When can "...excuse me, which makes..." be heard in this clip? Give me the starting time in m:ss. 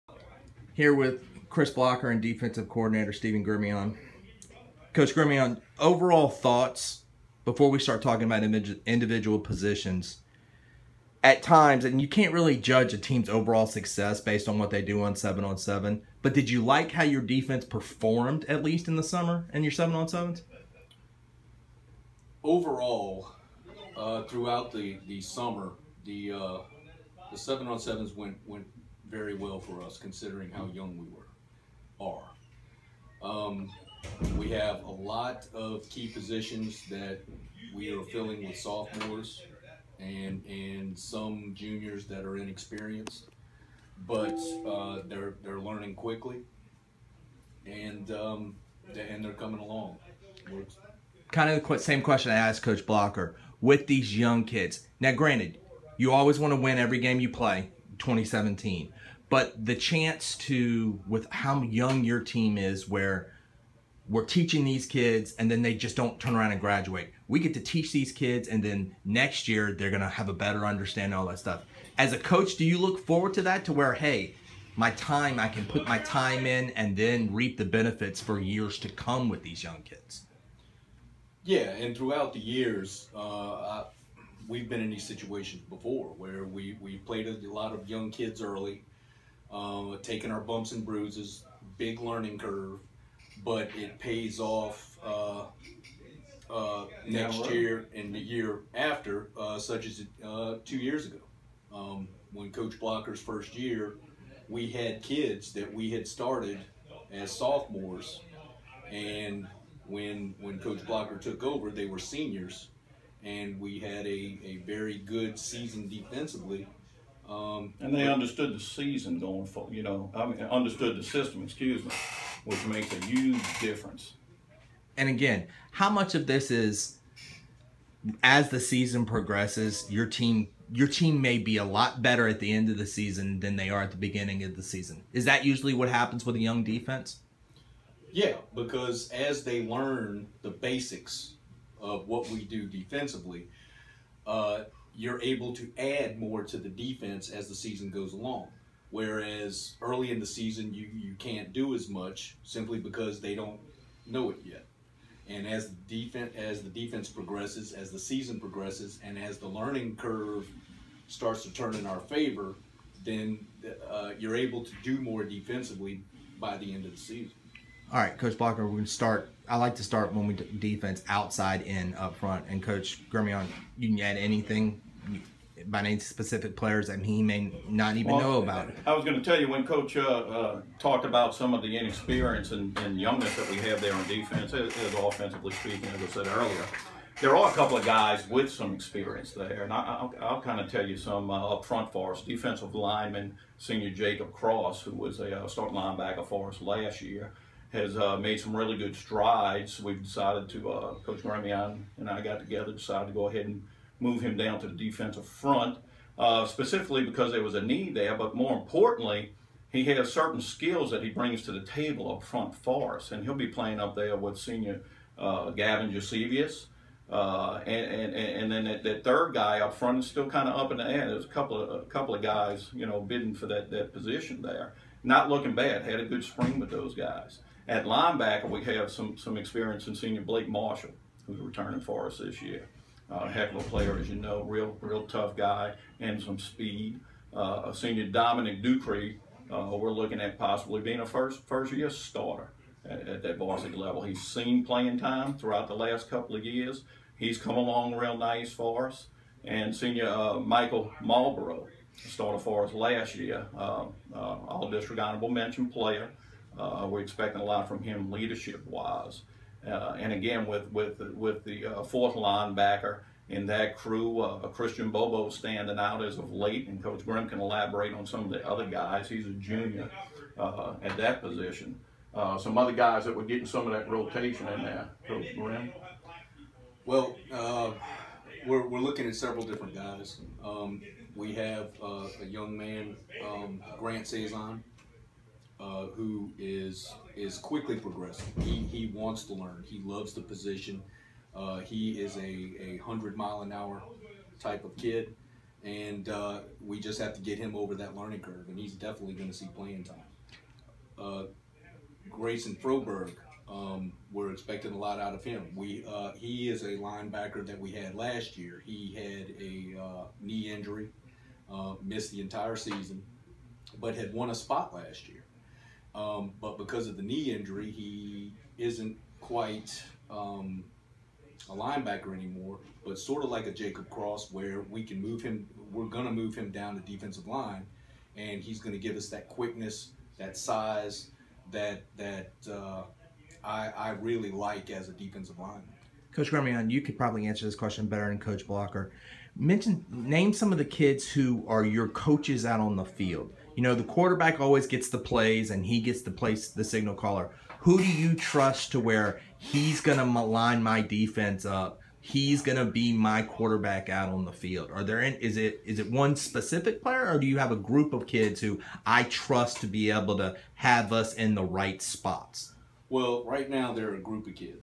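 2:01.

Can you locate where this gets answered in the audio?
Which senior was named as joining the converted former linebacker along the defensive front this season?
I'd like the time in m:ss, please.
3:35.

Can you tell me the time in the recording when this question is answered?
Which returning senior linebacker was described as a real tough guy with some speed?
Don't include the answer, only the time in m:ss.
3:50.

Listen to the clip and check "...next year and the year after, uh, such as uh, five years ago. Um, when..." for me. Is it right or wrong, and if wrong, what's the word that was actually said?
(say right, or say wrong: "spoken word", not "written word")
wrong: "two", not "five".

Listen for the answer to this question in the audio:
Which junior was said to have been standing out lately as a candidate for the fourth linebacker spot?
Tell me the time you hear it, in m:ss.
4:24.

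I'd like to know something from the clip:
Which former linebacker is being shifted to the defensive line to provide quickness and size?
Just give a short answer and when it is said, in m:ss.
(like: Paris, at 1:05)
Grayson Froberg, at 5:02.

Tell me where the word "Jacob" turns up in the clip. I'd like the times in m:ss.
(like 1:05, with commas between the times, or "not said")
3:13, 5:23.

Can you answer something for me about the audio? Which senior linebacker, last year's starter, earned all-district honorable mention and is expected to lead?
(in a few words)
Michael Marlborough.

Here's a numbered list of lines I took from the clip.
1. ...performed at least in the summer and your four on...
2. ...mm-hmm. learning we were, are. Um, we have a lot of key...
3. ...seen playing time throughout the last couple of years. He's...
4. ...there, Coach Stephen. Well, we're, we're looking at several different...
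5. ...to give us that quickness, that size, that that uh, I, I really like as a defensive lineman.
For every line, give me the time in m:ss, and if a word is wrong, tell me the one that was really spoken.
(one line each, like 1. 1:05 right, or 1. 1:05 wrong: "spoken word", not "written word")
1. 0:17 wrong: "seven", not "four"
2. 0:30 wrong: "young", not "learning"
3. 4:04 right
4. 4:34 wrong: "Grimm", not "Stephen"
5. 5:28 right.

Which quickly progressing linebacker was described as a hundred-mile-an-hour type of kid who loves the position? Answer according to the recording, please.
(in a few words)
Grant Saison.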